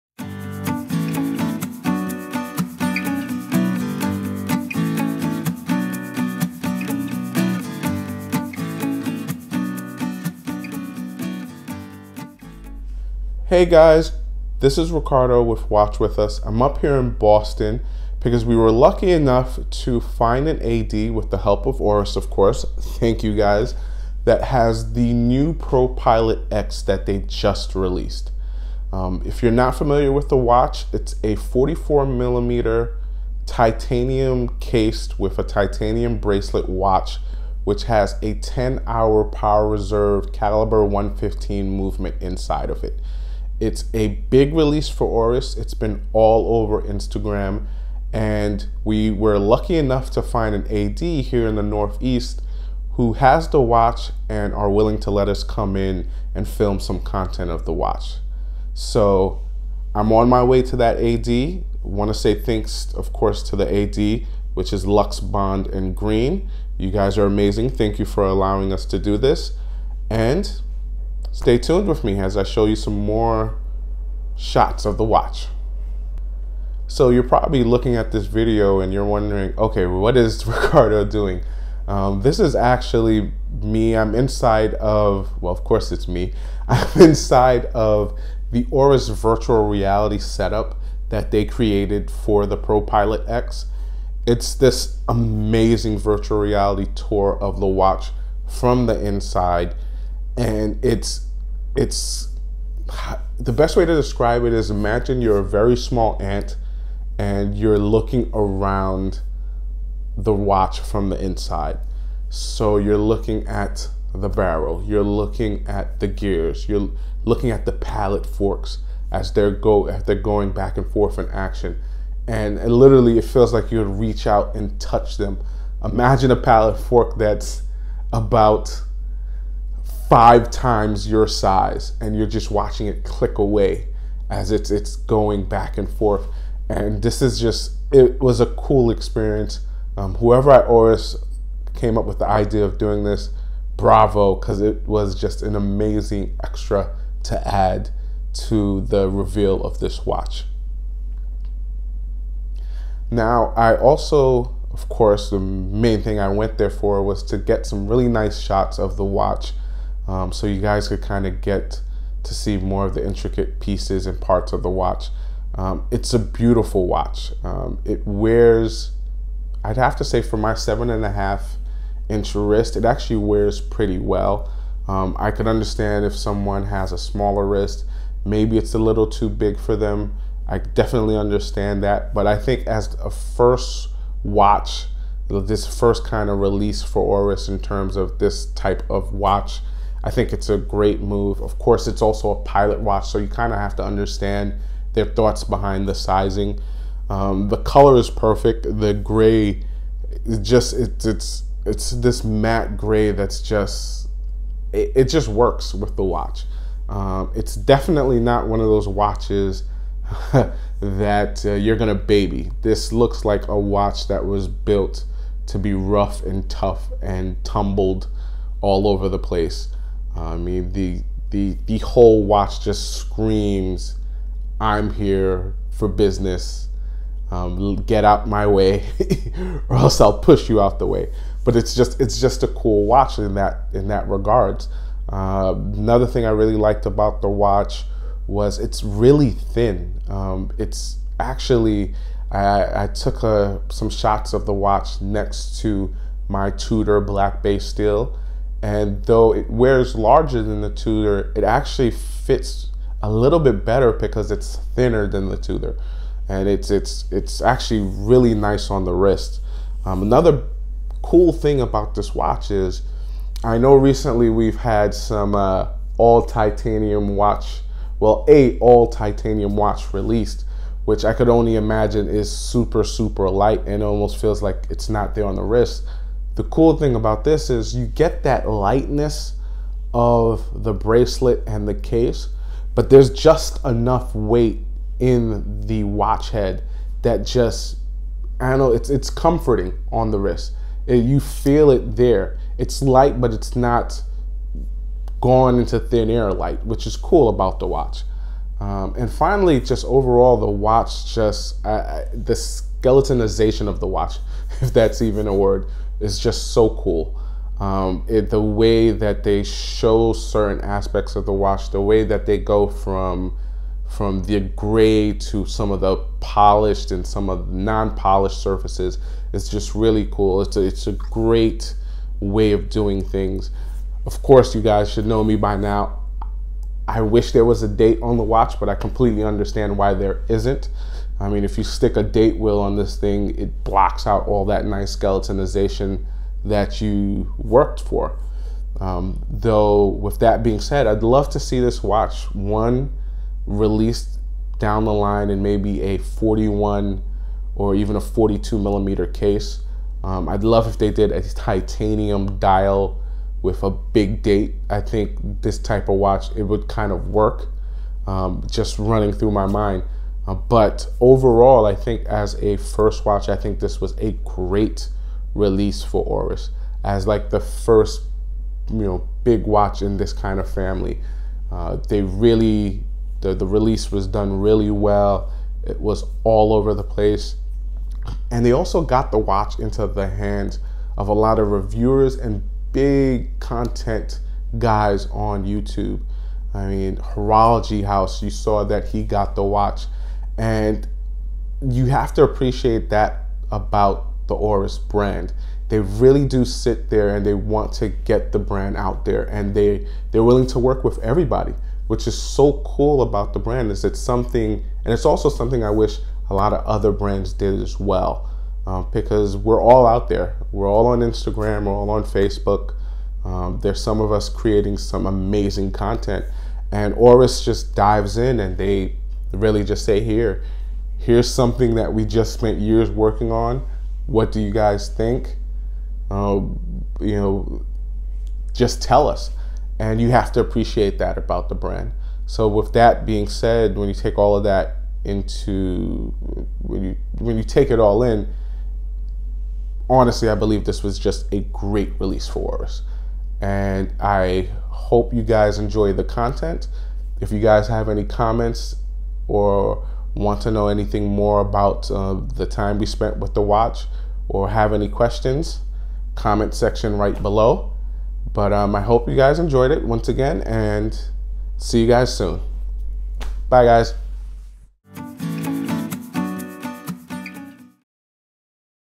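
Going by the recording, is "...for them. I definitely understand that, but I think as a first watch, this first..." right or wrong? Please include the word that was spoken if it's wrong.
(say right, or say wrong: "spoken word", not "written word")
right.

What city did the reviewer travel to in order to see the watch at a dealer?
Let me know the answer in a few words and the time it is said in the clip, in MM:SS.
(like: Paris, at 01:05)
Boston, at 00:17.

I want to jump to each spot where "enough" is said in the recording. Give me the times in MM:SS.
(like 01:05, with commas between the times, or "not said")
00:19, 00:49, 04:43.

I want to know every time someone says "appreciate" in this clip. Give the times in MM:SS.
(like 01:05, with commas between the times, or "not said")
06:32, 07:10.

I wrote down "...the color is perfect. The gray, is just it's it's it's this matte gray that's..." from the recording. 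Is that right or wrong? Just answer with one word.
right.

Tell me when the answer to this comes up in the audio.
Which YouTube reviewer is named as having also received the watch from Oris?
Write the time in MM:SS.
06:26.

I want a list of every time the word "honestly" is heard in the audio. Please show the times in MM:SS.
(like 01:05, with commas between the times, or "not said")
07:19.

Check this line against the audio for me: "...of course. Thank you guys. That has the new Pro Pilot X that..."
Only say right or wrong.
right.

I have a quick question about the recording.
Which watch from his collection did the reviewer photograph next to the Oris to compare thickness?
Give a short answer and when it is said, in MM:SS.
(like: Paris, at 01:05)
Tudor Black Bay, at 04:06.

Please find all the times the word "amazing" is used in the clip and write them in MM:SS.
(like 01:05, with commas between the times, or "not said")
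01:07, 01:35, 02:25, 06:55.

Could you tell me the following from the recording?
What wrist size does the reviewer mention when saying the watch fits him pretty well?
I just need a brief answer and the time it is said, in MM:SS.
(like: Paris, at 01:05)
7.5 inches, at 02:50.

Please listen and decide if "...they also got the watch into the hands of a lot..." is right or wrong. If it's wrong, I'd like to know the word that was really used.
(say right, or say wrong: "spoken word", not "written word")
right.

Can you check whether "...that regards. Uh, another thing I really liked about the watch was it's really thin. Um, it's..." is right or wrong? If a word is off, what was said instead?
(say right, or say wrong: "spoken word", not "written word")
right.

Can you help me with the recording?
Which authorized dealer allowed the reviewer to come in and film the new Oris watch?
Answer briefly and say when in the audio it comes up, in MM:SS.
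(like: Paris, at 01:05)
Lux Bond and Green, at 01:04.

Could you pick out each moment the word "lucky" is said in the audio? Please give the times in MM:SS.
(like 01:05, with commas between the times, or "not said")
00:18, 00:49.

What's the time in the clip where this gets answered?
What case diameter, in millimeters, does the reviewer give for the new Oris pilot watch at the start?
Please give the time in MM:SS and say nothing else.
00:31.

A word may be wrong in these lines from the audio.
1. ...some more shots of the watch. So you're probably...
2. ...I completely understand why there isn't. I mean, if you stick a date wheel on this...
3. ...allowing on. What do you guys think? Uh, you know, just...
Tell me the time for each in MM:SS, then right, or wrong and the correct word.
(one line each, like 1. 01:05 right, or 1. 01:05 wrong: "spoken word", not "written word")
1. 01:12 right
2. 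05:28 right
3. 07:02 wrong: "working", not "allowing".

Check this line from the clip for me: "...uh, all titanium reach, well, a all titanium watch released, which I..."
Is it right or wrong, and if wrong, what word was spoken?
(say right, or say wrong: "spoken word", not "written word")
wrong: "watch", not "reach".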